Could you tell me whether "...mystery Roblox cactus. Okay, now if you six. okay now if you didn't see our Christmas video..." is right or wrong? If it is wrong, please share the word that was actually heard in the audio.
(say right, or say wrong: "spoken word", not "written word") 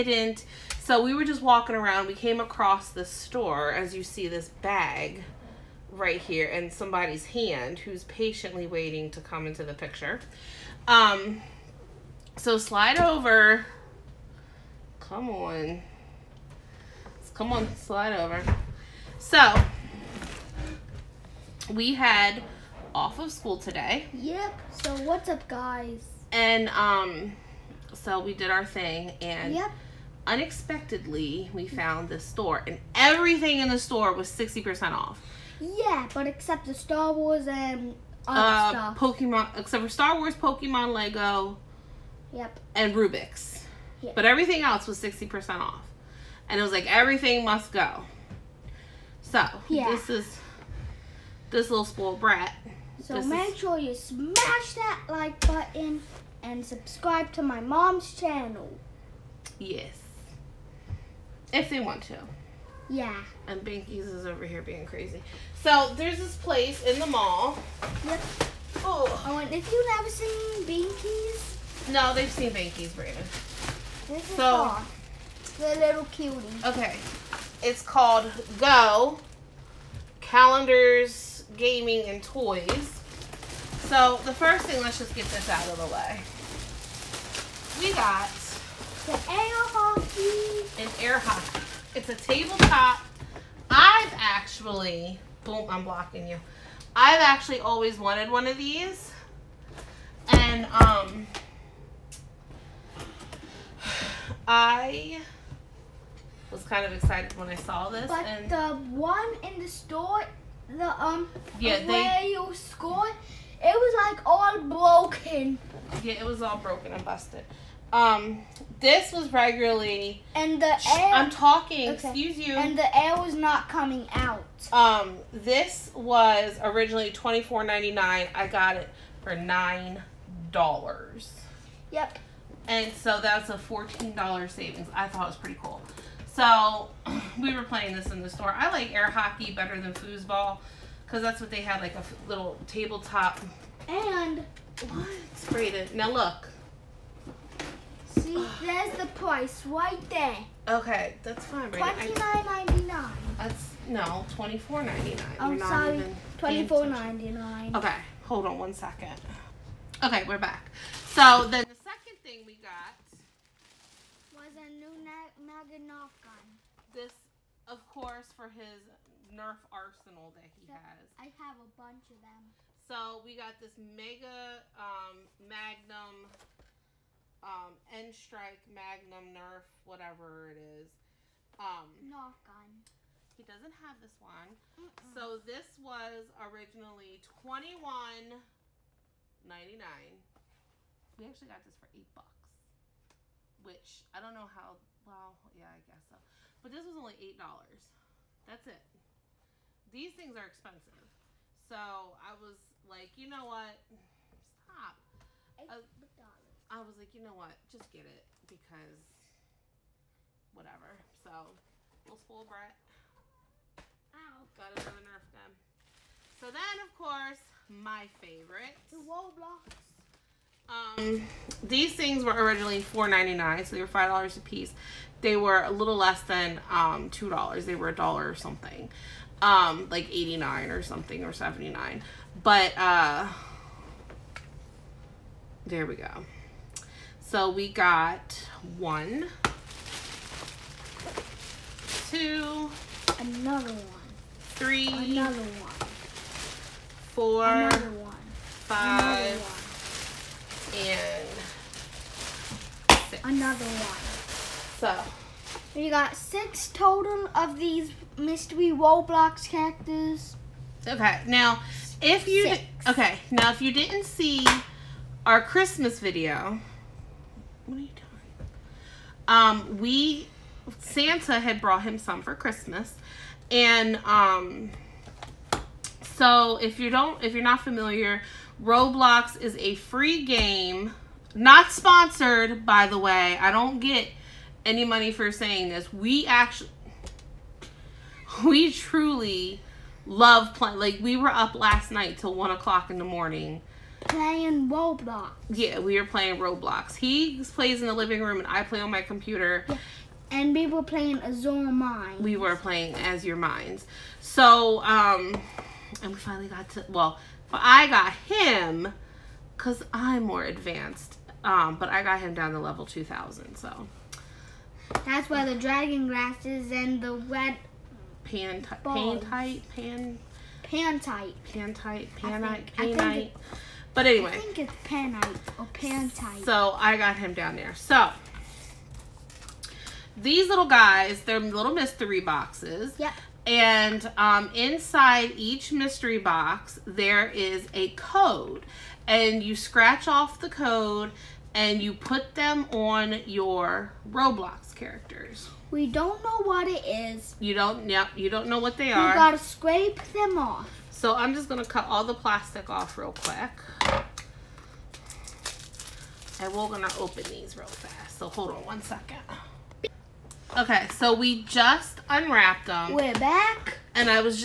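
right.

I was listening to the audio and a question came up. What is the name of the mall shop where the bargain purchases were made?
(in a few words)
Go Calendars, Gaming, and Toys.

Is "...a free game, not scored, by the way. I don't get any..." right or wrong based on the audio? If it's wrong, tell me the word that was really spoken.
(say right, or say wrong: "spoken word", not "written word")
wrong: "sponsored", not "scored".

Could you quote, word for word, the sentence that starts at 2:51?
I have a bunch of them.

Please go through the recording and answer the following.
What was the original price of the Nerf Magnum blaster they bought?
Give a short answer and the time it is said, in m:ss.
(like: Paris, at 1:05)
$21.99, at 3:07.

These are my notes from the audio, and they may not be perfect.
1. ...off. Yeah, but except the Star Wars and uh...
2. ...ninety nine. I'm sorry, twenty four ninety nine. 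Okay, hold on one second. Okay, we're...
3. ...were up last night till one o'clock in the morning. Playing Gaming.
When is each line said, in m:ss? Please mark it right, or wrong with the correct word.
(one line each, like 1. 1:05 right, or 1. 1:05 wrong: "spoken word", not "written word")
1. 0:34 right
2. 2:34 right
3. 4:51 wrong: "Roblox", not "Gaming".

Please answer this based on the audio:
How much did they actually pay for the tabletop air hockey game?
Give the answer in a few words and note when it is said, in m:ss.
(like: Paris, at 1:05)
$9, at 2:09.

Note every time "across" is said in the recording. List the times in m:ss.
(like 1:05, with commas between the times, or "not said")
0:02.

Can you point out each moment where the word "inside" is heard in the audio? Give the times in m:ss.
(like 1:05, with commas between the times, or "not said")
5:34.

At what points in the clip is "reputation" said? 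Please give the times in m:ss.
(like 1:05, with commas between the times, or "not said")
not said.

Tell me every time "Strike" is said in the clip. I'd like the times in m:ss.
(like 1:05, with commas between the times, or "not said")
2:57.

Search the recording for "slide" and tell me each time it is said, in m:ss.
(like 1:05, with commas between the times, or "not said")
0:12, 0:17.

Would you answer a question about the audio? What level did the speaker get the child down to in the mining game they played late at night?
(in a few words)
2000.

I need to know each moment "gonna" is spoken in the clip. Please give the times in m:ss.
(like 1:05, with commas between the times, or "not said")
5:51, 5:56.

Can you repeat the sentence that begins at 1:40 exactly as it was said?
And um, I was kind of excited when I saw this.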